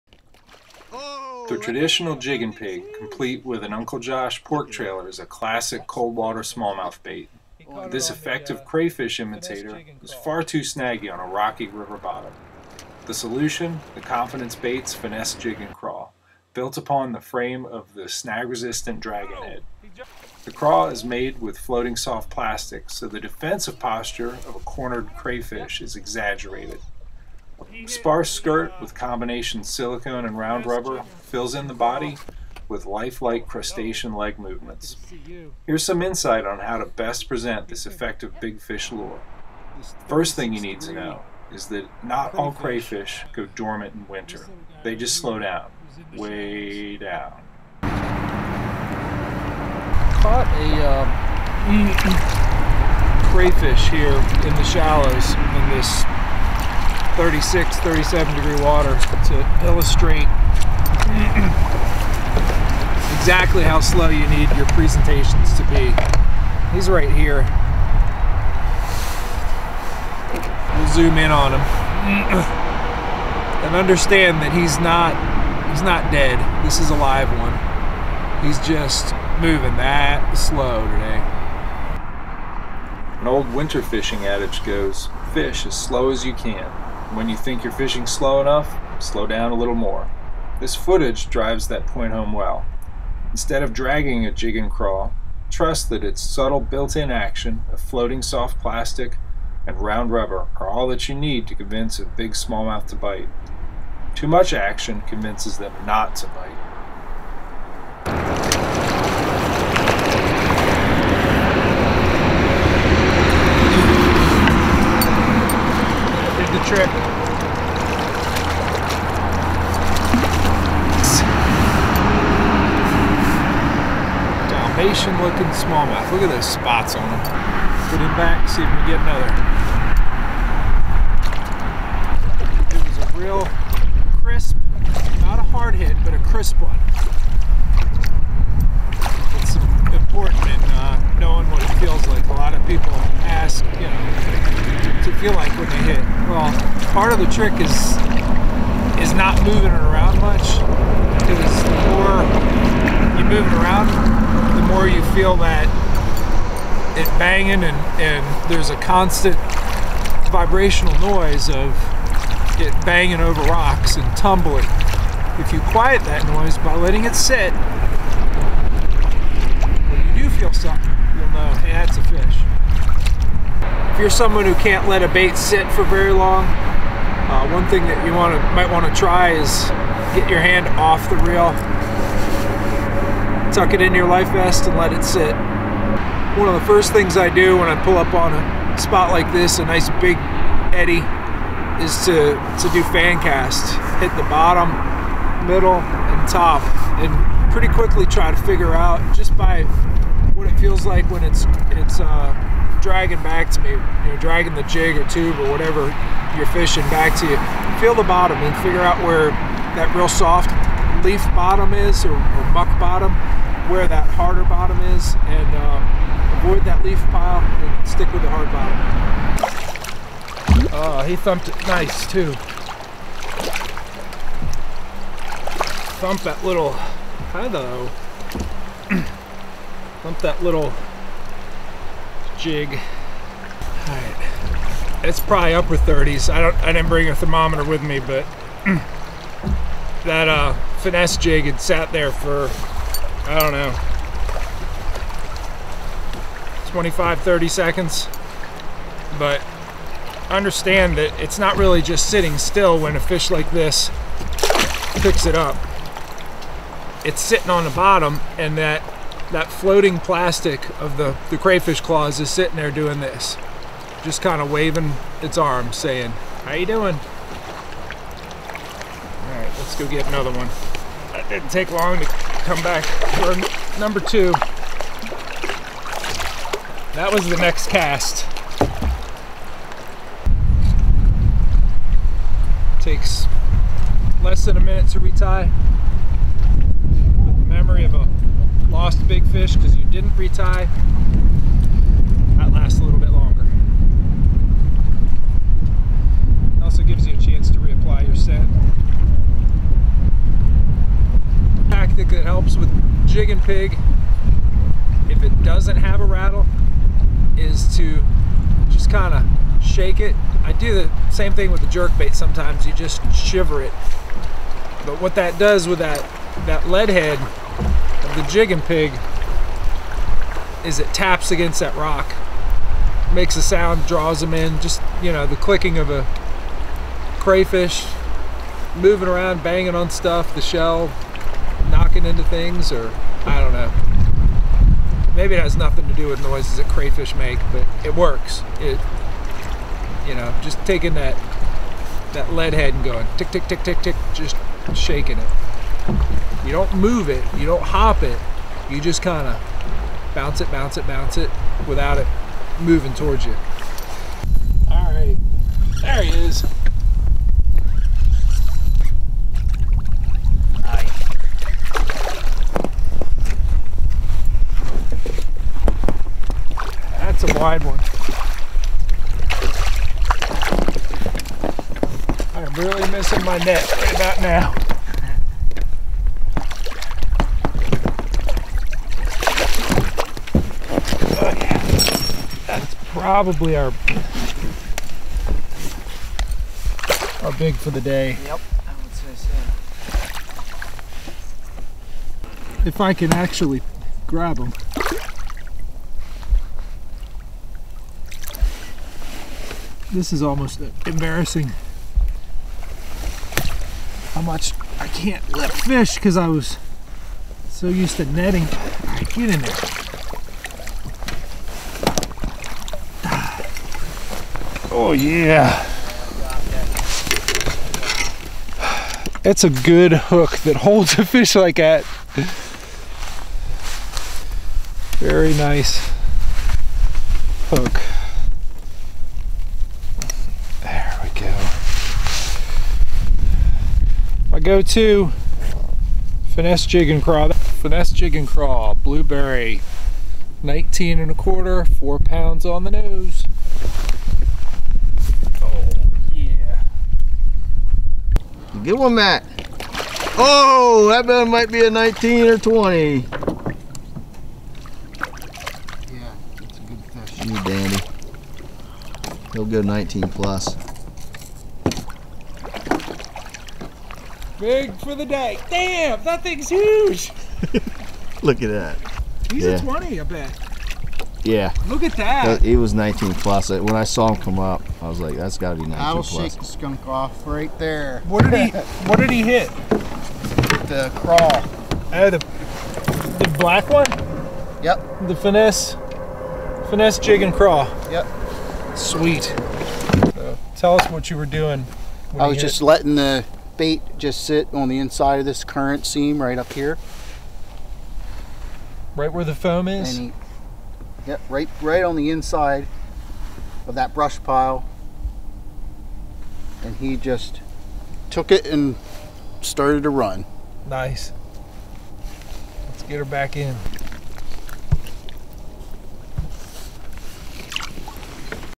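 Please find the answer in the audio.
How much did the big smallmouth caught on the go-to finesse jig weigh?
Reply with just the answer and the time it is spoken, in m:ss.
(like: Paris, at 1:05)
4 pounds, at 7:21.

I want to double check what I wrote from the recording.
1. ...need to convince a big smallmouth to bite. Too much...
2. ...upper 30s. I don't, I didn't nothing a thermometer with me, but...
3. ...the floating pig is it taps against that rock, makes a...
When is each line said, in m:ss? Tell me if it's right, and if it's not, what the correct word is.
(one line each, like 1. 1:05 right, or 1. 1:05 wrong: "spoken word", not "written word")
1. 1:41 right
2. 3:55 wrong: "bring", not "nothing"
3. 5:18 wrong: "jigging", not "floating".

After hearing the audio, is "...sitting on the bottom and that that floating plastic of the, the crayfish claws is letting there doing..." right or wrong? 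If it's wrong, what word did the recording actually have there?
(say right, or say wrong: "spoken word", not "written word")
wrong: "sitting", not "letting".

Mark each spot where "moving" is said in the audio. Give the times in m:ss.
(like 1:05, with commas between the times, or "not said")
1:19, 2:29, 5:28, 5:52.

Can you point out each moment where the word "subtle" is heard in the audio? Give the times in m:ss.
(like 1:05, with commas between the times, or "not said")
1:36.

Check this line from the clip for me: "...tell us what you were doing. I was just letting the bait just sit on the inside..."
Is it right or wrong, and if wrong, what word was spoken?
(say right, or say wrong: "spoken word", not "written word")
right.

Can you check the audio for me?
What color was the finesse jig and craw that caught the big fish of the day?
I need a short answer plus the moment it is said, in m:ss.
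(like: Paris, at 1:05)
blueberry, at 7:18.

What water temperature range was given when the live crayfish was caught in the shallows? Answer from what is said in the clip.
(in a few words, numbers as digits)
36-37 degrees.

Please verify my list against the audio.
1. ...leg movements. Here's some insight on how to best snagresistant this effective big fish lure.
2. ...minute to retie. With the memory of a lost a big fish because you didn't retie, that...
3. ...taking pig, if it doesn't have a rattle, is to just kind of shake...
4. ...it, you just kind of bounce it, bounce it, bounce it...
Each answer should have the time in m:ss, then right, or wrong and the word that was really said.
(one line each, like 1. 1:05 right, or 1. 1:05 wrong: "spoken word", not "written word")
1. 0:34 wrong: "present", not "snagresistant"
2. 4:44 right
3. 5:03 wrong: "jigging", not "taking"
4. 5:48 right.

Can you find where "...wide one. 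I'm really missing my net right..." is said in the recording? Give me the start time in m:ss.
6:07.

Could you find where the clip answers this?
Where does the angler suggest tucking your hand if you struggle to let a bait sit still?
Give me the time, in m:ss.
3:04.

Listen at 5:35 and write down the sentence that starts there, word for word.
Maybe it has nothing to do with noises that crayfish make, but it works.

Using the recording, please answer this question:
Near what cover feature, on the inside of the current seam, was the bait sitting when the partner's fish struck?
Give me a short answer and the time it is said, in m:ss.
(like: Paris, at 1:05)
brush pile, at 8:23.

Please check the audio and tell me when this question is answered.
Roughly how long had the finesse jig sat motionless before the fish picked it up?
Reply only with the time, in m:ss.
4:06.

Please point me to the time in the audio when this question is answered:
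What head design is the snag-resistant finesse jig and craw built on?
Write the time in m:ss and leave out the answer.
0:19.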